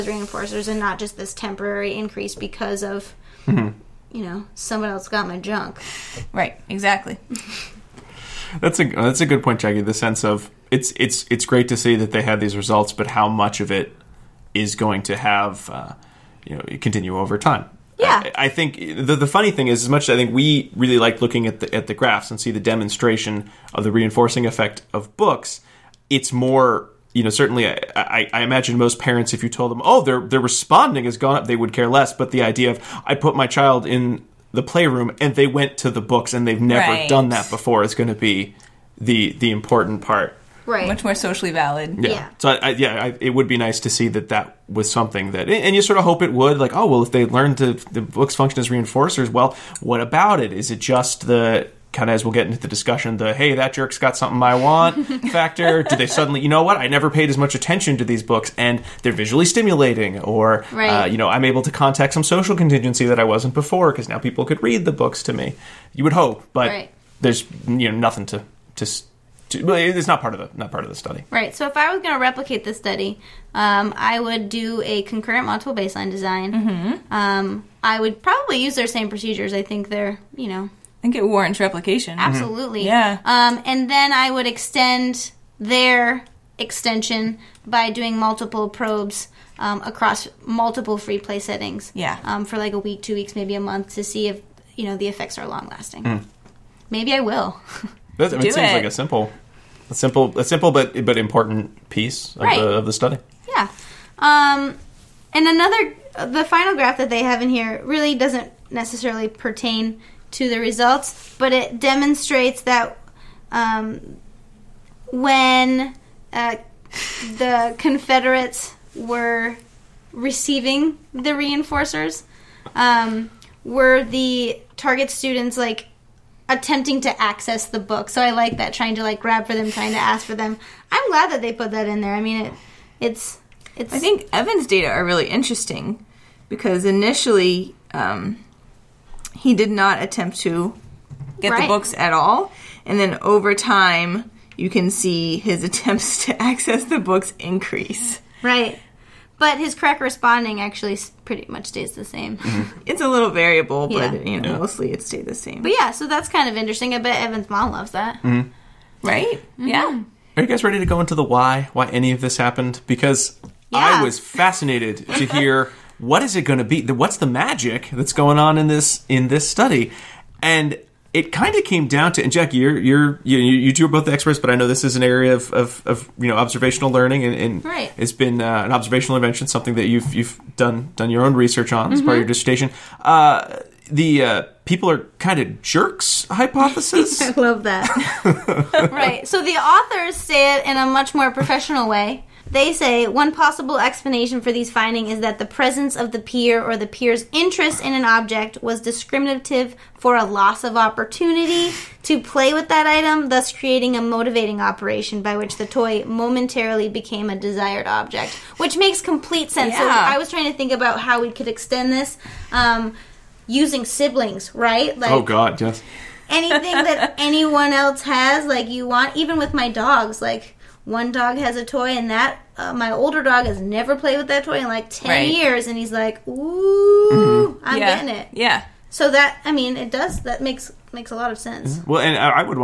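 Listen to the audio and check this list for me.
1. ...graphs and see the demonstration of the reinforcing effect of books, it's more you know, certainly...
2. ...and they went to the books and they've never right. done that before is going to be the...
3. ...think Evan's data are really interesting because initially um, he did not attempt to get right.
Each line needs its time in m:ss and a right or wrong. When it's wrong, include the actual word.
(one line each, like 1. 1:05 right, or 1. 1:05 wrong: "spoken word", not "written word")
1. 0:21 right
2. 0:35 right
3. 2:13 right.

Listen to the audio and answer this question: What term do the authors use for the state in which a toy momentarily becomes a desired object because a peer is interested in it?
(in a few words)
motivating operation.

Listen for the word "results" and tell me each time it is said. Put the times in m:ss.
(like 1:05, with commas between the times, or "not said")
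0:12, 1:50.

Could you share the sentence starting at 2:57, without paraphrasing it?
it's been uh, an observational invention, something that you've you've done done your own research on mm-hmm.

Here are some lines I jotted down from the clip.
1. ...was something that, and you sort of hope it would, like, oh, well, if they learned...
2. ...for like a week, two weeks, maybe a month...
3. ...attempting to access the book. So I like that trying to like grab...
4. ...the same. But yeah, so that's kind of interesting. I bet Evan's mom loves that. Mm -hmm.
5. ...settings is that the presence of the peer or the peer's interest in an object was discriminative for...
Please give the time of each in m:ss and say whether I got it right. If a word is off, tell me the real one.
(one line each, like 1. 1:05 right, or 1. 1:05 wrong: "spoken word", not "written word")
1. 0:44 right
2. 1:32 right
3. 2:06 right
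4. 2:35 right
5. 3:14 wrong: "findings", not "settings".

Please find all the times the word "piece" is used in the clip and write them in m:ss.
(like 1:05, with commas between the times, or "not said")
1:41.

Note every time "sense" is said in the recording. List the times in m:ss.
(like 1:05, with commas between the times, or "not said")
0:09, 3:29, 3:51.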